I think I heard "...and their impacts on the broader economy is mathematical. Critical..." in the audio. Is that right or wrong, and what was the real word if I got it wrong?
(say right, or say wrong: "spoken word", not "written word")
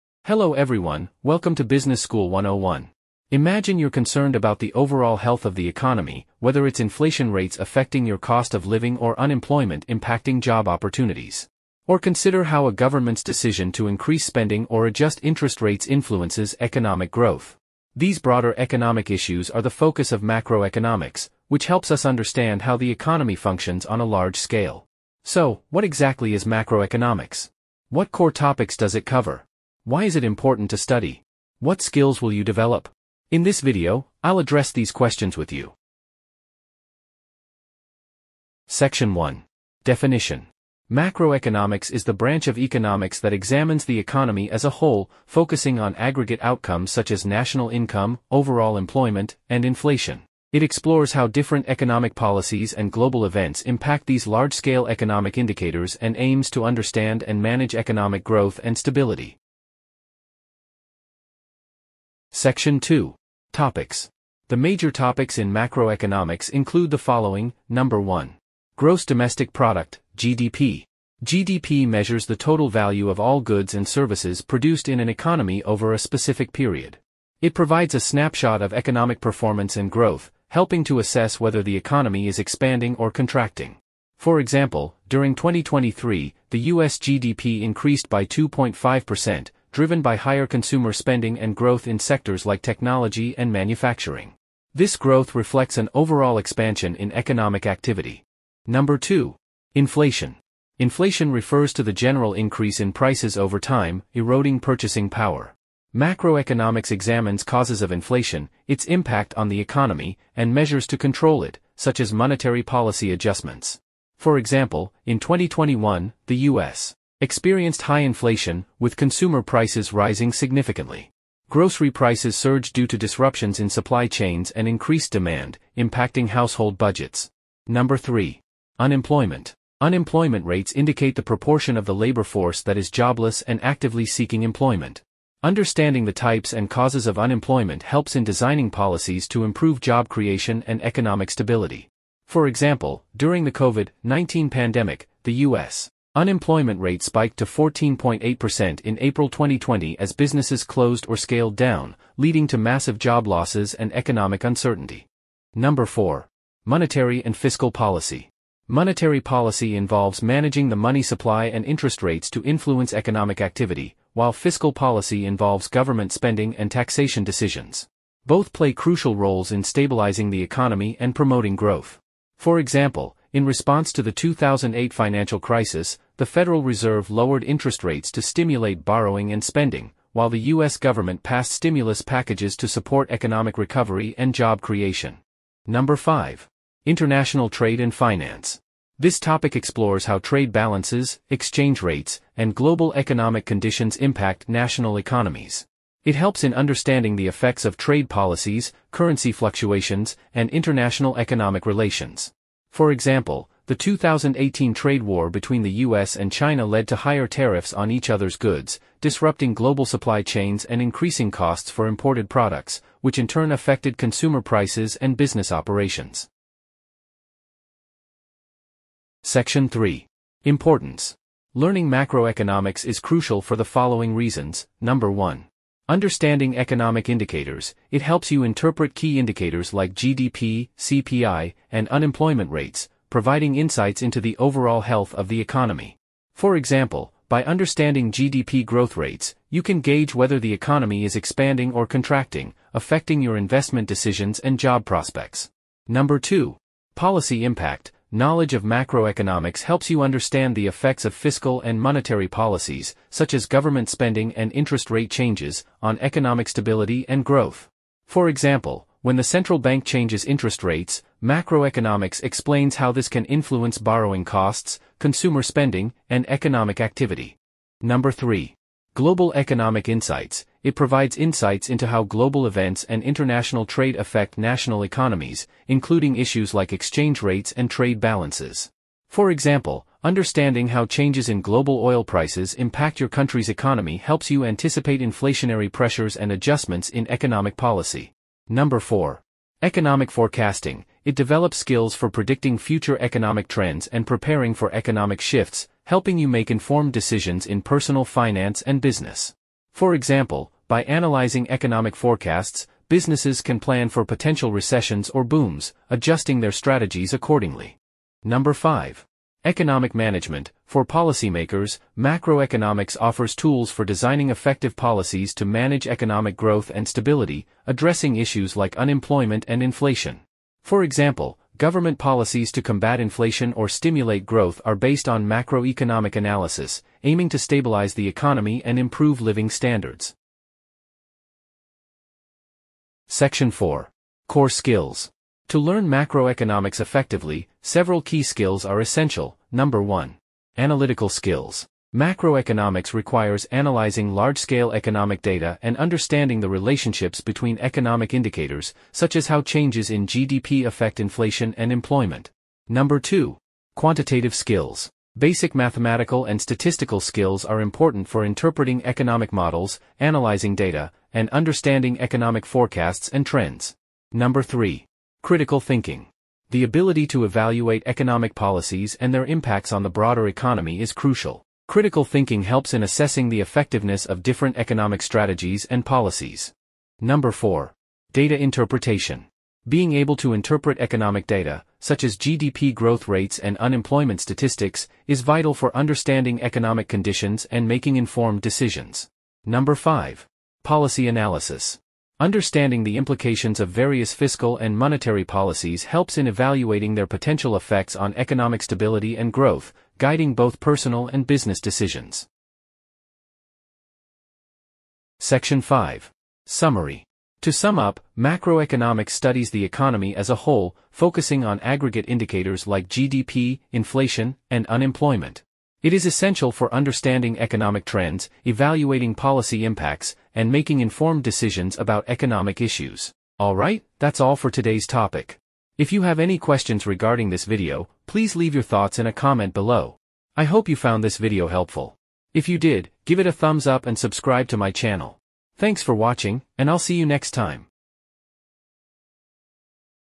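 wrong: "crucial", not "mathematical".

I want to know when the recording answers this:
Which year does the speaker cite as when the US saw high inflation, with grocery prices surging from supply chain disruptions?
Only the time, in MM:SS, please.
01:55.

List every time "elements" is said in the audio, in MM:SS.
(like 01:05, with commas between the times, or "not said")
not said.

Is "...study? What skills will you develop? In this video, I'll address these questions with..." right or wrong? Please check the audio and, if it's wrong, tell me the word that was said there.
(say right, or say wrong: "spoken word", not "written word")
right.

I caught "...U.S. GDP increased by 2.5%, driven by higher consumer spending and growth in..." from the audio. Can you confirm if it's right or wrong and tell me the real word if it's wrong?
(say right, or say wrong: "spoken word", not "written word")
right.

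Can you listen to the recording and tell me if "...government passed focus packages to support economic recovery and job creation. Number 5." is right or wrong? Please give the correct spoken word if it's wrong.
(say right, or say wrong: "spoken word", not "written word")
wrong: "stimulus", not "focus".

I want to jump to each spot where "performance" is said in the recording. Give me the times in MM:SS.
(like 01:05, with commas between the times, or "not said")
01:19.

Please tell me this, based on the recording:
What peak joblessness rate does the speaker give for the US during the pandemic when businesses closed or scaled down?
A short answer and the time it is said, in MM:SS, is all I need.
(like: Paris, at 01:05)
14.8%, at 02:27.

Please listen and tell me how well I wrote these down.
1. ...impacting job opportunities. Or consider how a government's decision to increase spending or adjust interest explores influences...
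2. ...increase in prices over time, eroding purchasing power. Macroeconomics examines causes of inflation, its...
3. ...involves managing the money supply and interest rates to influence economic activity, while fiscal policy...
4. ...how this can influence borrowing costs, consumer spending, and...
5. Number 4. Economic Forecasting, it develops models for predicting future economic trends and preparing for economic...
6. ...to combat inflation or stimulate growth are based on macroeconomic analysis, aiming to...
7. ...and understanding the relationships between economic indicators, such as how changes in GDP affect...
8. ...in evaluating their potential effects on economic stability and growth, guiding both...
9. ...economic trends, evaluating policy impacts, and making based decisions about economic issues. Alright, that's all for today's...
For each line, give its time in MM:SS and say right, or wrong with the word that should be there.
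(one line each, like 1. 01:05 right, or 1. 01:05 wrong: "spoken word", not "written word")
1. 00:09 wrong: "rates", not "explores"
2. 01:42 right
3. 02:39 right
4. 04:22 right
5. 04:48 wrong: "skills", not "models"
6. 05:22 right
7. 05:45 right
8. 06:36 right
9. 06:57 wrong: "informed", not "based".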